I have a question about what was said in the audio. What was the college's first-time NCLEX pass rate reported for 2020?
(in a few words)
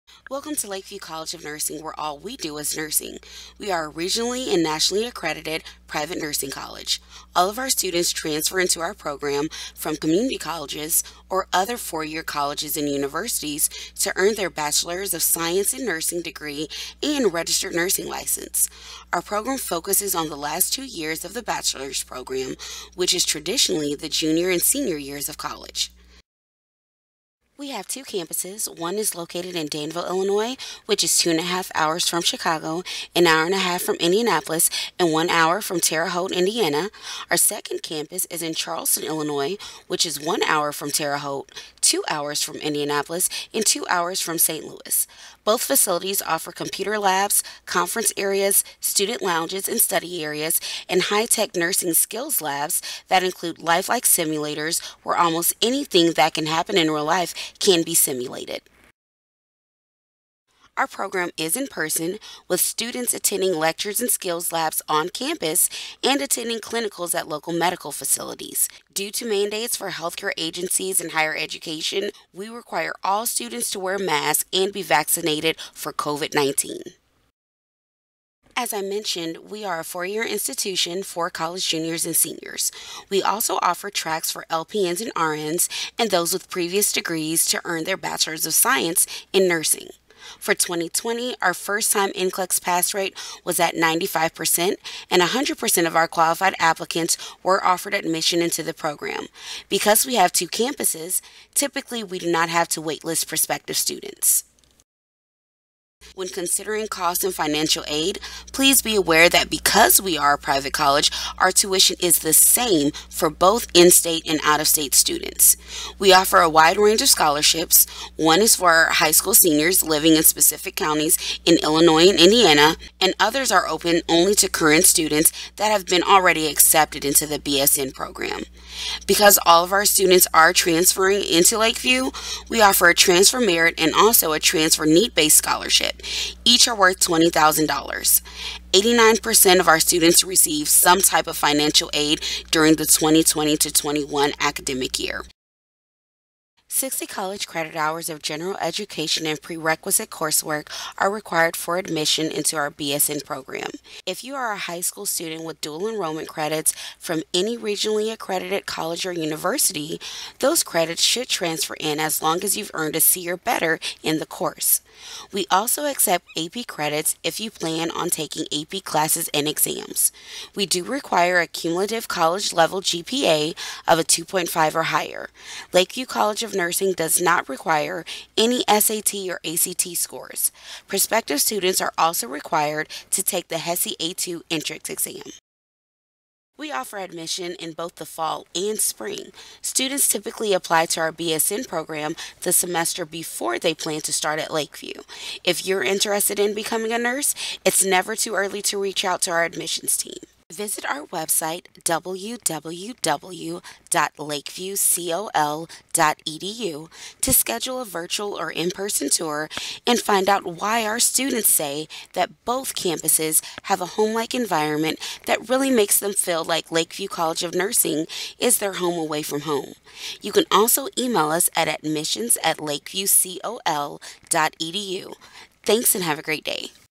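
95%.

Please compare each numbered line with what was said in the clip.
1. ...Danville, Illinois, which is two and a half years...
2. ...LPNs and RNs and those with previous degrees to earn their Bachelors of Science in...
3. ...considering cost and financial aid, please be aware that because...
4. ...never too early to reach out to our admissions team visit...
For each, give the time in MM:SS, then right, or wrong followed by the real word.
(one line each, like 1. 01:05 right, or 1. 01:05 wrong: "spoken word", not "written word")
1. 00:29 wrong: "hours", not "years"
2. 01:24 right
3. 01:46 right
4. 03:17 right.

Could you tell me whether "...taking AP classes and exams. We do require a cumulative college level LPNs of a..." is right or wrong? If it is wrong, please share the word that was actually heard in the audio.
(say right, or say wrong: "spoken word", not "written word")
wrong: "GPA", not "LPNs".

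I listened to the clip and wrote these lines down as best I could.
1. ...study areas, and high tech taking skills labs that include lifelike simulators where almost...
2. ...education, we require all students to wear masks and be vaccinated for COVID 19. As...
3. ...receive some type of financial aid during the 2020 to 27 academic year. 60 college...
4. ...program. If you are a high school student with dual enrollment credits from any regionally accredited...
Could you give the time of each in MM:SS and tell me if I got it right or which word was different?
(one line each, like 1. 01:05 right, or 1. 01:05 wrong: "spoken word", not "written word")
1. 00:49 wrong: "nursing", not "taking"
2. 01:11 right
3. 02:20 wrong: "21", not "27"
4. 02:33 right.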